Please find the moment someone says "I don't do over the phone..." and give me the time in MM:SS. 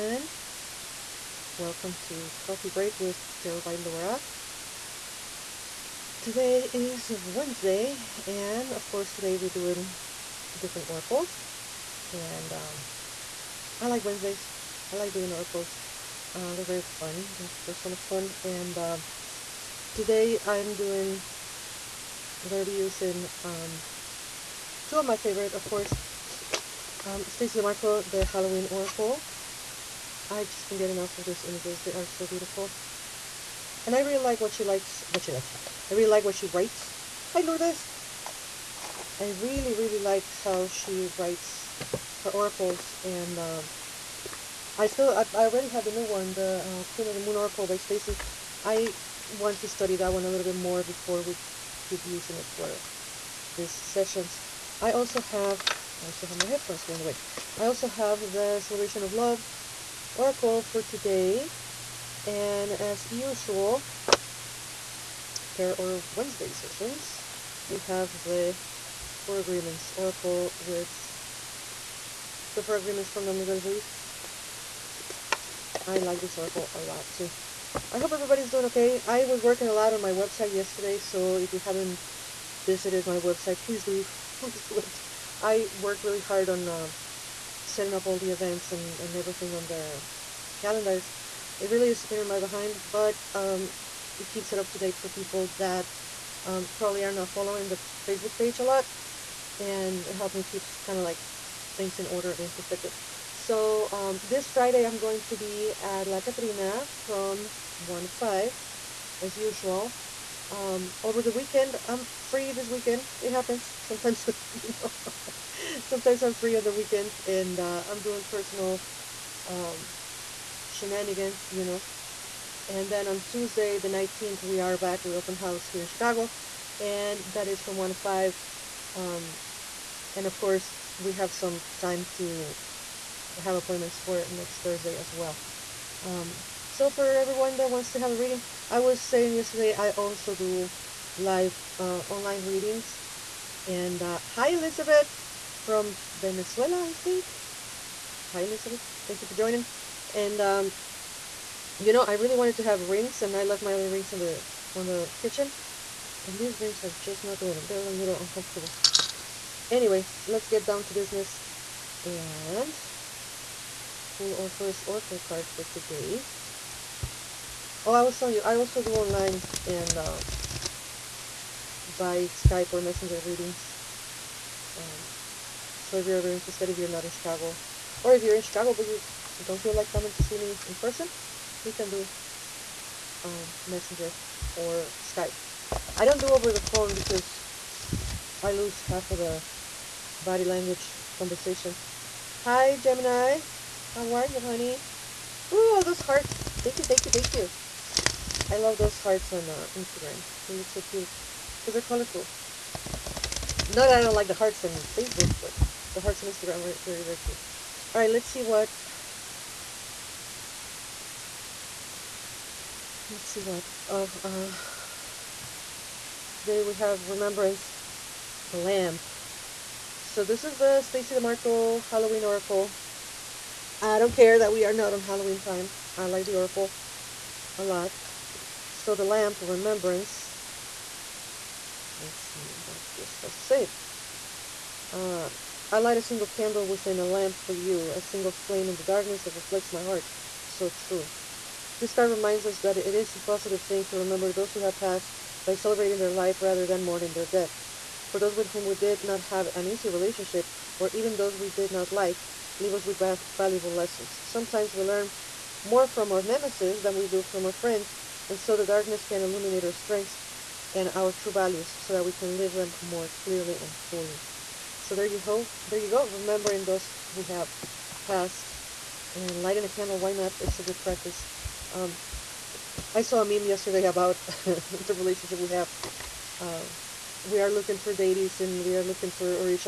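03:05.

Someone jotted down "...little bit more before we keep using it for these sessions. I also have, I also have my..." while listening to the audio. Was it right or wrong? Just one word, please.
right.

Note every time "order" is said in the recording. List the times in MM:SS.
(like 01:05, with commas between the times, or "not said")
01:42.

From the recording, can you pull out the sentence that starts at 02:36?
And these rings are just not doing it.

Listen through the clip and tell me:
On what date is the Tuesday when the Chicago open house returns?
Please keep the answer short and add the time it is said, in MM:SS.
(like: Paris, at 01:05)
19th, at 02:03.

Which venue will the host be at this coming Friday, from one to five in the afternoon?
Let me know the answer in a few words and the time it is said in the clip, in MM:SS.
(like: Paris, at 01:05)
La Catrina, at 01:46.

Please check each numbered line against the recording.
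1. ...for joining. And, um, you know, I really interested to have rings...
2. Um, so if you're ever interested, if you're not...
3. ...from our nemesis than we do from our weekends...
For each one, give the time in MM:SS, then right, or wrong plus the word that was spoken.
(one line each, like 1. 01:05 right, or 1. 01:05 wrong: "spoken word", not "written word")
1. 02:29 wrong: "wanted", not "interested"
2. 02:54 right
3. 04:15 wrong: "friends", not "weekends".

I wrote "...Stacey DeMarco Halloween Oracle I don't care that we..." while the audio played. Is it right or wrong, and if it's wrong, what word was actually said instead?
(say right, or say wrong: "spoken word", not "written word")
right.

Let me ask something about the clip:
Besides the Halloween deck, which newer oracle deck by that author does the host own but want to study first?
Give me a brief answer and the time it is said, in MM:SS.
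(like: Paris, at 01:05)
Queen of the Moon Oracle, at 00:46.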